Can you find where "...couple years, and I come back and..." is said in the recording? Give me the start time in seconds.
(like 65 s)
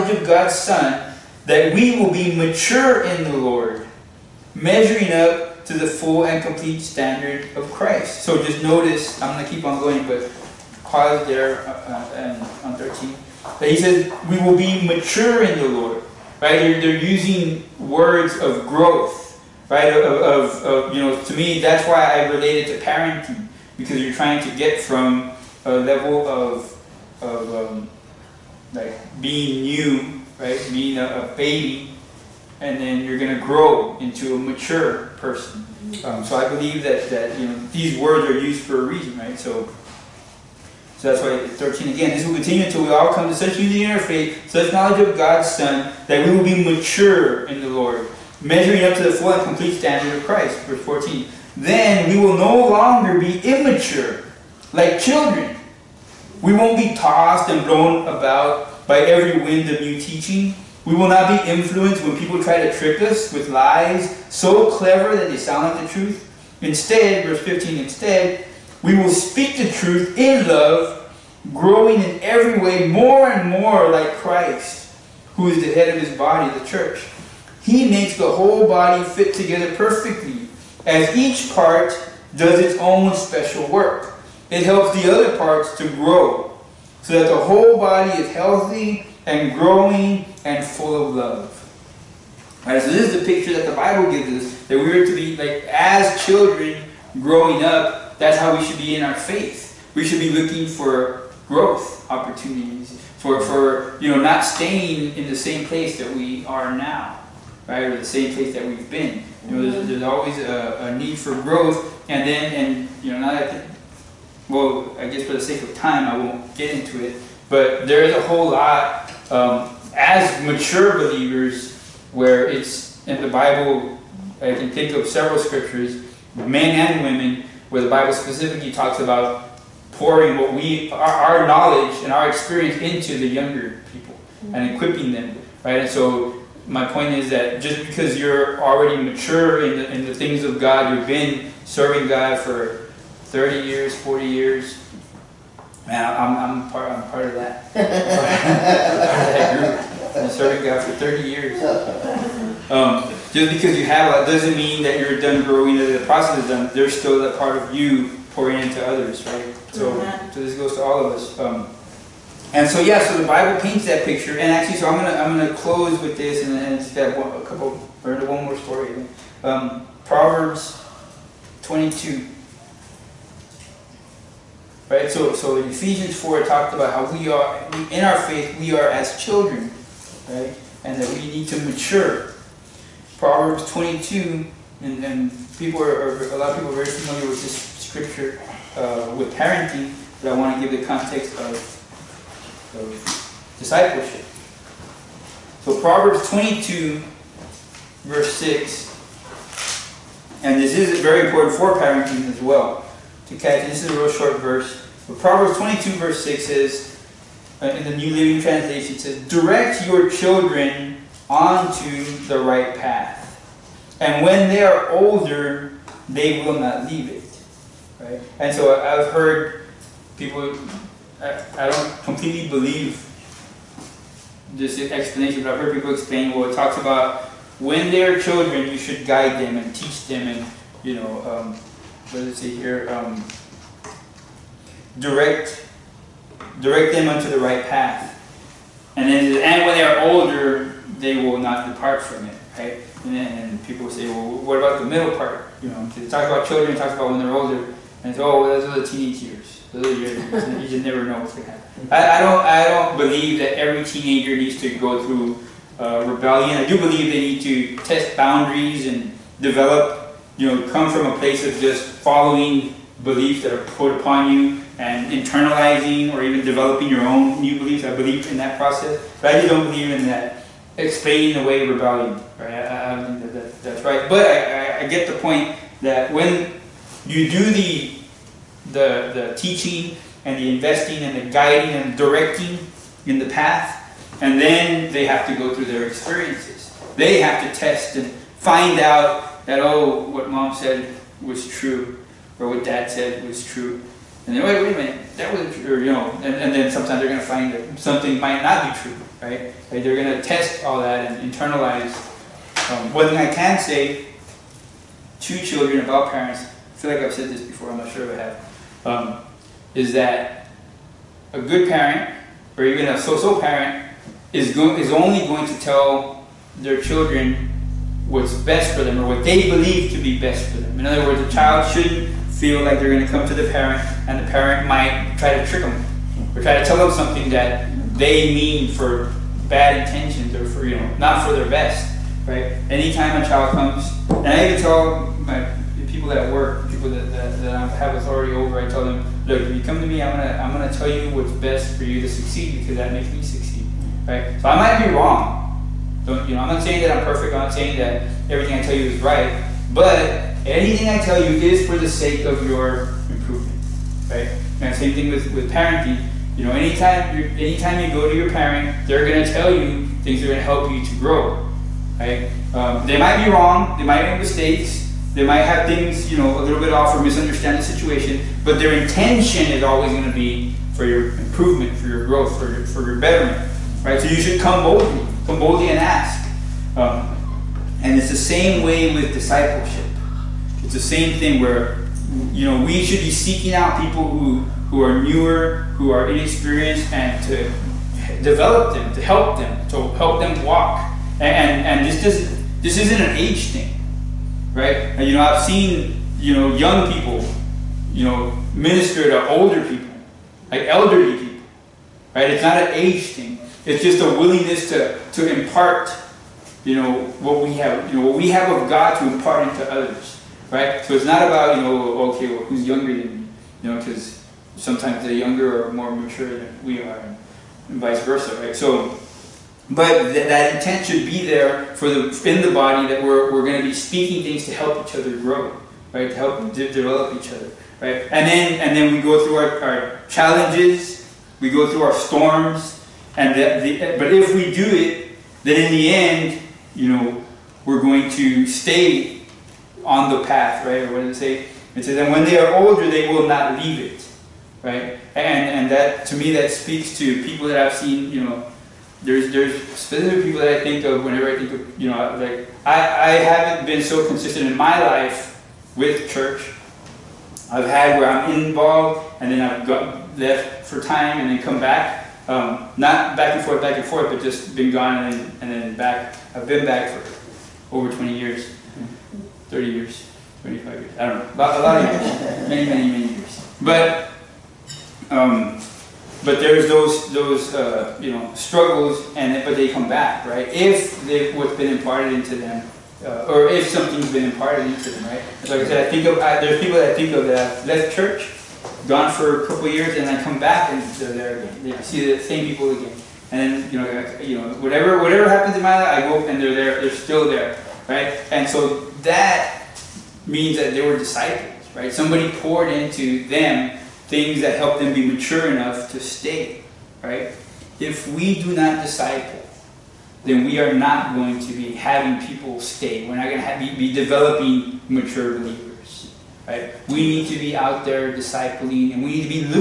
489 s.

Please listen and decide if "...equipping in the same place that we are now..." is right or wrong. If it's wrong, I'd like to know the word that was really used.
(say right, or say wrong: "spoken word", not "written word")
wrong: "staying", not "equipping".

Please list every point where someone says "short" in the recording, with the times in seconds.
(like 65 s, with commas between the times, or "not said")
204 s.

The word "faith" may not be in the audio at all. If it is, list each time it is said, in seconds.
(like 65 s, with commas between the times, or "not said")
43 s, 99 s, 178 s.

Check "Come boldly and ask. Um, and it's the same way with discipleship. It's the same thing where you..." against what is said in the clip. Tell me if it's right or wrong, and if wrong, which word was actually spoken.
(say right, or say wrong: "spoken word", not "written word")
right.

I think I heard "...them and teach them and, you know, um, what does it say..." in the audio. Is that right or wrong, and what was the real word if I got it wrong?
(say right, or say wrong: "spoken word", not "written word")
right.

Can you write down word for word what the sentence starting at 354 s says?
And same thing with, with parenting.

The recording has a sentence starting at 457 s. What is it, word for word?
I've had where I'm involved and then I've got left for time and then come back.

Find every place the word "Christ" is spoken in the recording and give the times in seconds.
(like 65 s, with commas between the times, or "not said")
7 s, 50 s, 74 s.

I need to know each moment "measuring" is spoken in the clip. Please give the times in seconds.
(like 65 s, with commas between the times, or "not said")
4 s, 48 s.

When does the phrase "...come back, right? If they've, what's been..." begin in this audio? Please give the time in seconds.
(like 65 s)
479 s.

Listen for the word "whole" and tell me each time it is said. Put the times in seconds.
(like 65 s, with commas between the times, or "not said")
78 s, 87 s, 118 s.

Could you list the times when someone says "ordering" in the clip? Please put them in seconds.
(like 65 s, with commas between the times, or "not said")
not said.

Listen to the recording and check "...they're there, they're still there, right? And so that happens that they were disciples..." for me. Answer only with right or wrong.
wrong.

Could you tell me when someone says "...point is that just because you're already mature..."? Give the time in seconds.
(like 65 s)
136 s.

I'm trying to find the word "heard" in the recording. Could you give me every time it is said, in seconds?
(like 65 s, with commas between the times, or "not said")
219 s, 225 s.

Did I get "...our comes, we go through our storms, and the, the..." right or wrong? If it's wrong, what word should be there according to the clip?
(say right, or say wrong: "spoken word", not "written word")
wrong: "challenges", not "comes".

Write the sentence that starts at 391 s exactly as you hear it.
And, and, and this, doesn't, this isn't an age thing, right?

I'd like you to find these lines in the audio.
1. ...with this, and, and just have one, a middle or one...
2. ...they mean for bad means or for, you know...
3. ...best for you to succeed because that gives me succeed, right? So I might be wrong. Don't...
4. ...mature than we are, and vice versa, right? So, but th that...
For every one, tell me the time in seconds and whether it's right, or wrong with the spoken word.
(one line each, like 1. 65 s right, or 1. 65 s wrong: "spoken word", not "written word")
1. 166 s wrong: "couple", not "middle"
2. 327 s wrong: "intentions", not "means"
3. 341 s wrong: "makes", not "gives"
4. 415 s right.